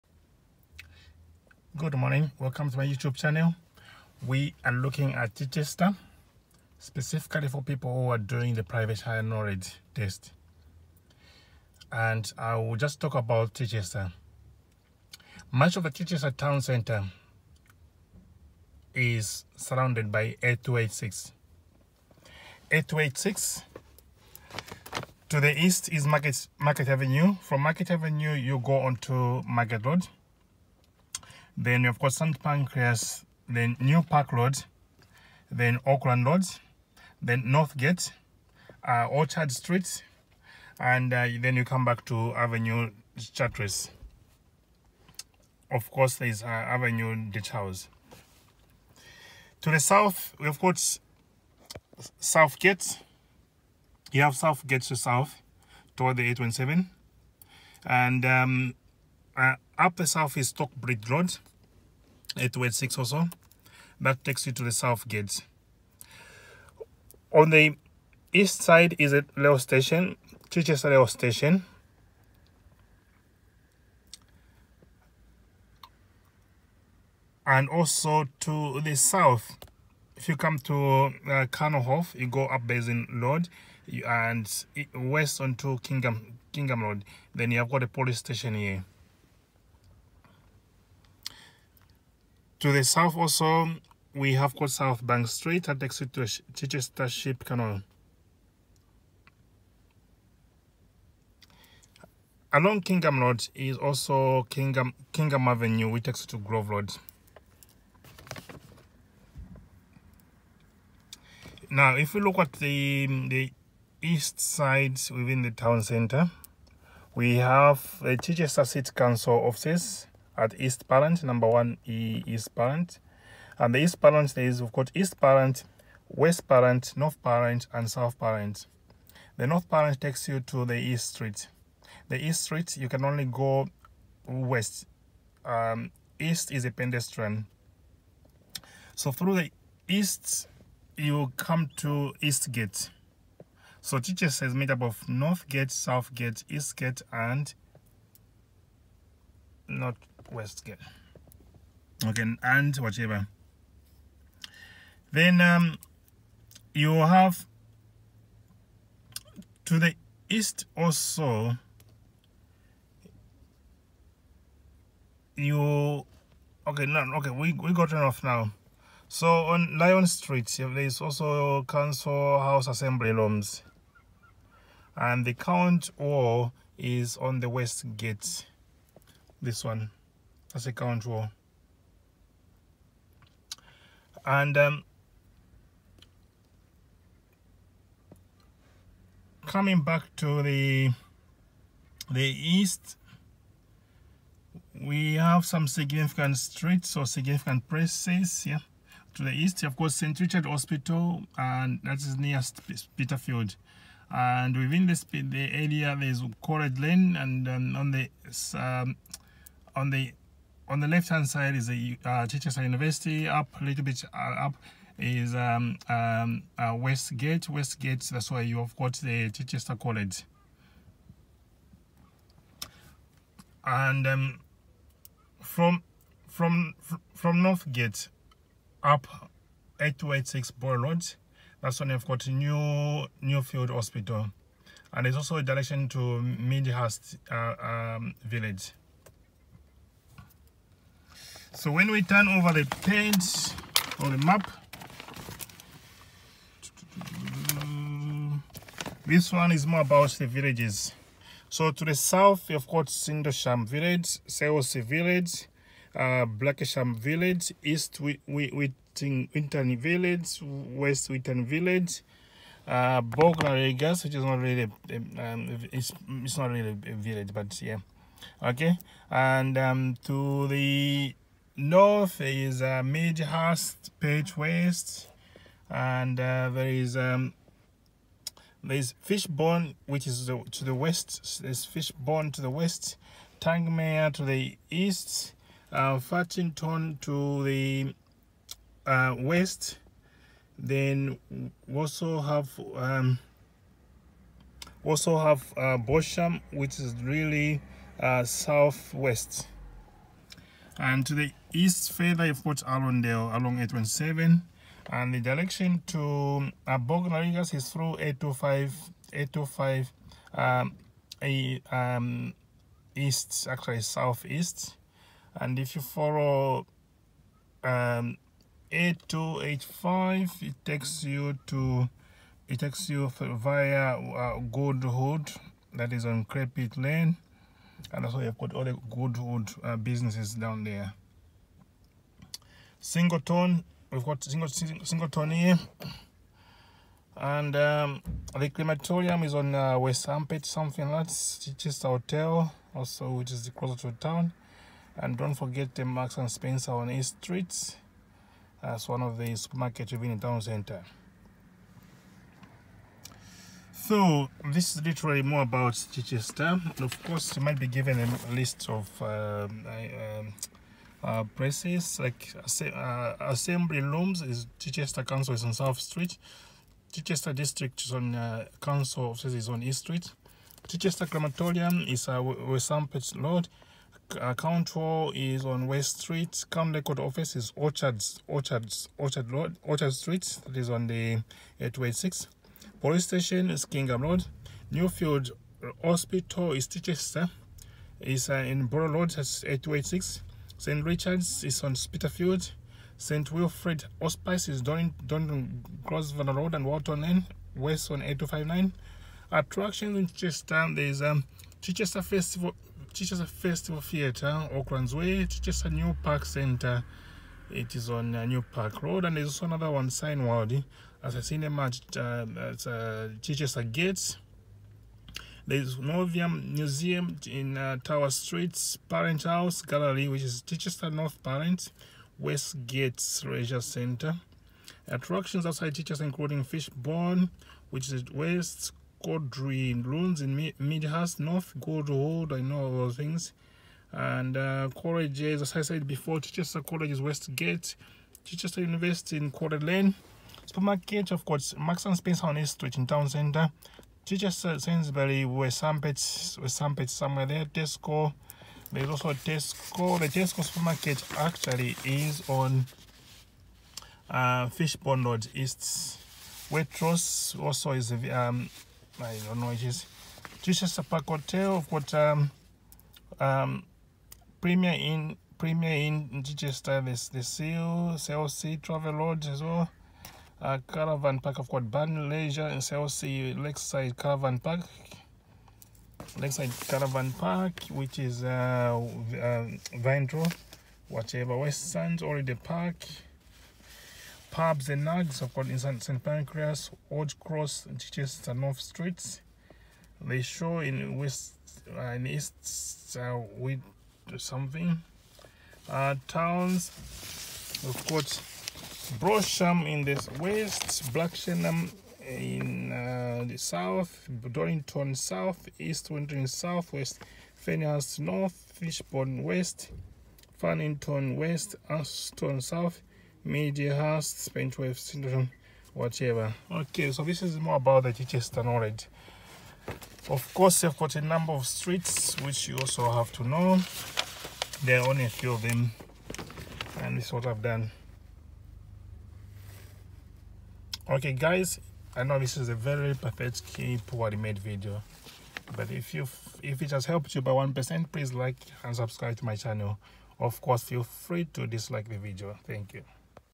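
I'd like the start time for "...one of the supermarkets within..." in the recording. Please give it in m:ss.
5:48.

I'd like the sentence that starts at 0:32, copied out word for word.
Pancras, then New Park Road, then Auckland Road, then Northgate, uh, Orchard Street, and uh, then you come back to Avenue Chartres.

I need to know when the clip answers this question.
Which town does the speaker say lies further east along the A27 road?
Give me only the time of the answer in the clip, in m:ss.
5:02.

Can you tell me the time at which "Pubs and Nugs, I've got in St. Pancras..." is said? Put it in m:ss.
8:04.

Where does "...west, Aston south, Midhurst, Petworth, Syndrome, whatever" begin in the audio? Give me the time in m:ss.
8:31.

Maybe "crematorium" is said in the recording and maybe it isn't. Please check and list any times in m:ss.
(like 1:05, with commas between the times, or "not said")
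5:38, 6:11.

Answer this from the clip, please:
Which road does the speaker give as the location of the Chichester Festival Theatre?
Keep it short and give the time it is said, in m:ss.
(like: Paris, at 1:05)
Oaklands Way, at 6:44.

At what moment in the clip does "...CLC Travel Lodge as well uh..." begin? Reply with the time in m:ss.
7:47.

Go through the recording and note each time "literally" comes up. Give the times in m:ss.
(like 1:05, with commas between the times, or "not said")
5:54.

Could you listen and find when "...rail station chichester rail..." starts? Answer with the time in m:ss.
1:09.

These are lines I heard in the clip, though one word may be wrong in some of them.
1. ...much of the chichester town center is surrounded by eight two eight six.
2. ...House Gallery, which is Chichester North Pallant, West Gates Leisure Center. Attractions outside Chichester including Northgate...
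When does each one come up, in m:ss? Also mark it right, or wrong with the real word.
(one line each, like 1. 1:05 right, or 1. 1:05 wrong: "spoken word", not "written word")
1. 0:15 right
2. 6:59 wrong: "Fishbourne", not "Northgate".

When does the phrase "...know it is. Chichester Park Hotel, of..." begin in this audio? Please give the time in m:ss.
7:39.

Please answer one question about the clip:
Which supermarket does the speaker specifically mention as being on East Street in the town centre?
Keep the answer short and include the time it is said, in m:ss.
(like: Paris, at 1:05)
Marks and Spencer, at 5:45.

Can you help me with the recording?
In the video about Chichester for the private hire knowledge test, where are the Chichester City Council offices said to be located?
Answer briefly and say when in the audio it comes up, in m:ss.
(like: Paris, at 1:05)
1 East Pallant, at 2:01.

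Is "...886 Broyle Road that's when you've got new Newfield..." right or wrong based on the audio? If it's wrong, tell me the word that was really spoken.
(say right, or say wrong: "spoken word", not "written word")
right.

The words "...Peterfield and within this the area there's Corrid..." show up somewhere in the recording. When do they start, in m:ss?
3:22.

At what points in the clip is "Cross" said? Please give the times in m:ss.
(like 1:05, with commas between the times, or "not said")
8:07.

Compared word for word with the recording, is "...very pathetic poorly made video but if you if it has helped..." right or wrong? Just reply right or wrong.
right.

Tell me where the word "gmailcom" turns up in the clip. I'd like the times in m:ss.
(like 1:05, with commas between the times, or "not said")
not said.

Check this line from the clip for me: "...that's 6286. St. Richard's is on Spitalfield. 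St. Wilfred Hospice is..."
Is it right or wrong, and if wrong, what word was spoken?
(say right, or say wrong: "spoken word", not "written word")
wrong: "8286", not "6286".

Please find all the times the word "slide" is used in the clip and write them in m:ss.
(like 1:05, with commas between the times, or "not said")
not said.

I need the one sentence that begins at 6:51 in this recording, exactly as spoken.
As a assassine churches Chichester gates.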